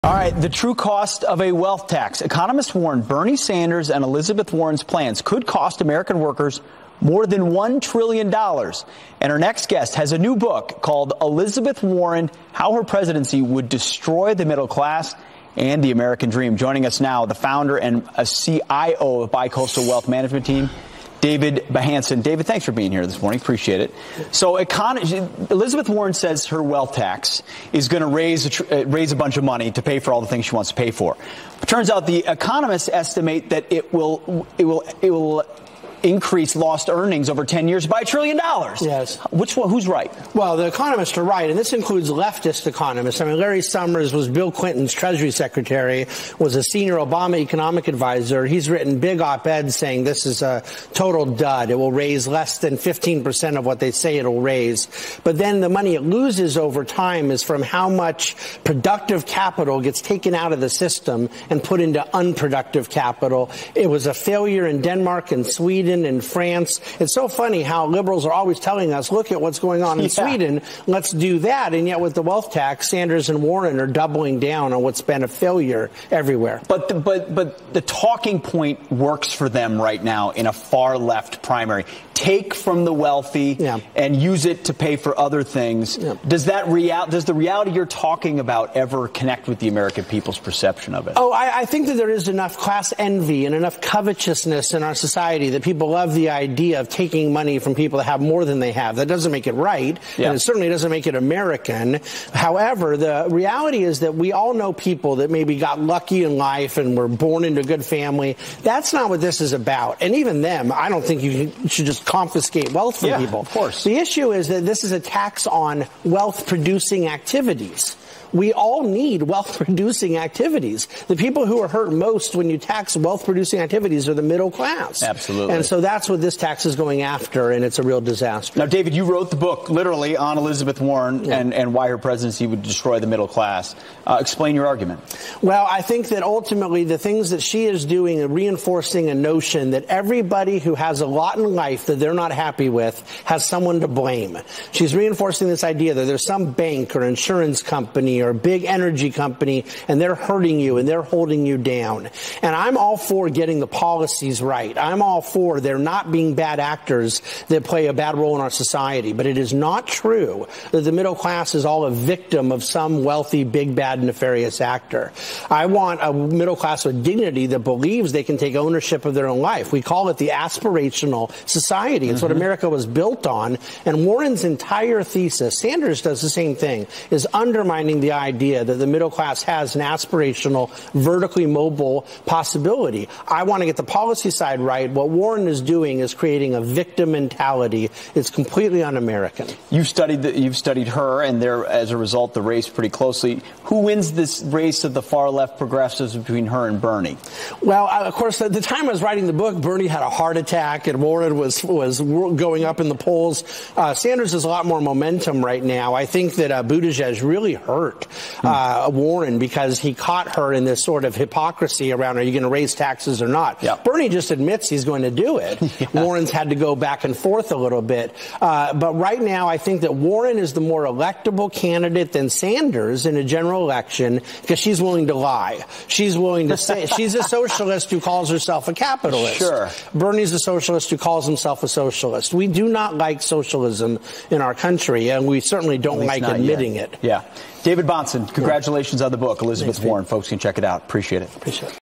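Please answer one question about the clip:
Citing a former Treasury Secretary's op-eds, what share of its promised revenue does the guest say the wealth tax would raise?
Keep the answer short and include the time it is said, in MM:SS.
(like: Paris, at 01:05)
less than 15%, at 00:52.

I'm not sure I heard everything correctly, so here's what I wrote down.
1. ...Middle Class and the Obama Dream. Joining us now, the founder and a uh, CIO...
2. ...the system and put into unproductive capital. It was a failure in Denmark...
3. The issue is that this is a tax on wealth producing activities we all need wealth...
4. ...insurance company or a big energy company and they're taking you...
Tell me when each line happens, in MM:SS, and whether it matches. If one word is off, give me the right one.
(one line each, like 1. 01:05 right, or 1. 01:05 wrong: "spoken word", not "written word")
1. 00:14 wrong: "American", not "Obama"
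2. 01:00 right
3. 01:53 right
4. 02:27 wrong: "hurting", not "taking".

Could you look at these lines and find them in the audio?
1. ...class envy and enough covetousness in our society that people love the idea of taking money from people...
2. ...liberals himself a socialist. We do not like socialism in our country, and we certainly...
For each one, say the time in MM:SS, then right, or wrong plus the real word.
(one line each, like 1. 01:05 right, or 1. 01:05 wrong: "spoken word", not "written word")
1. 01:32 right
2. 03:50 wrong: "calls", not "liberals".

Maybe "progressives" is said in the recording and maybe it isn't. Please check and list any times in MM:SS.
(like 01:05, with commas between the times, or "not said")
03:15.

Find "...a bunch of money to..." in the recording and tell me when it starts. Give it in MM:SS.
00:29.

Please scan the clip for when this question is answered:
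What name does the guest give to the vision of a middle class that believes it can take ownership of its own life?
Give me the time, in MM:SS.
02:50.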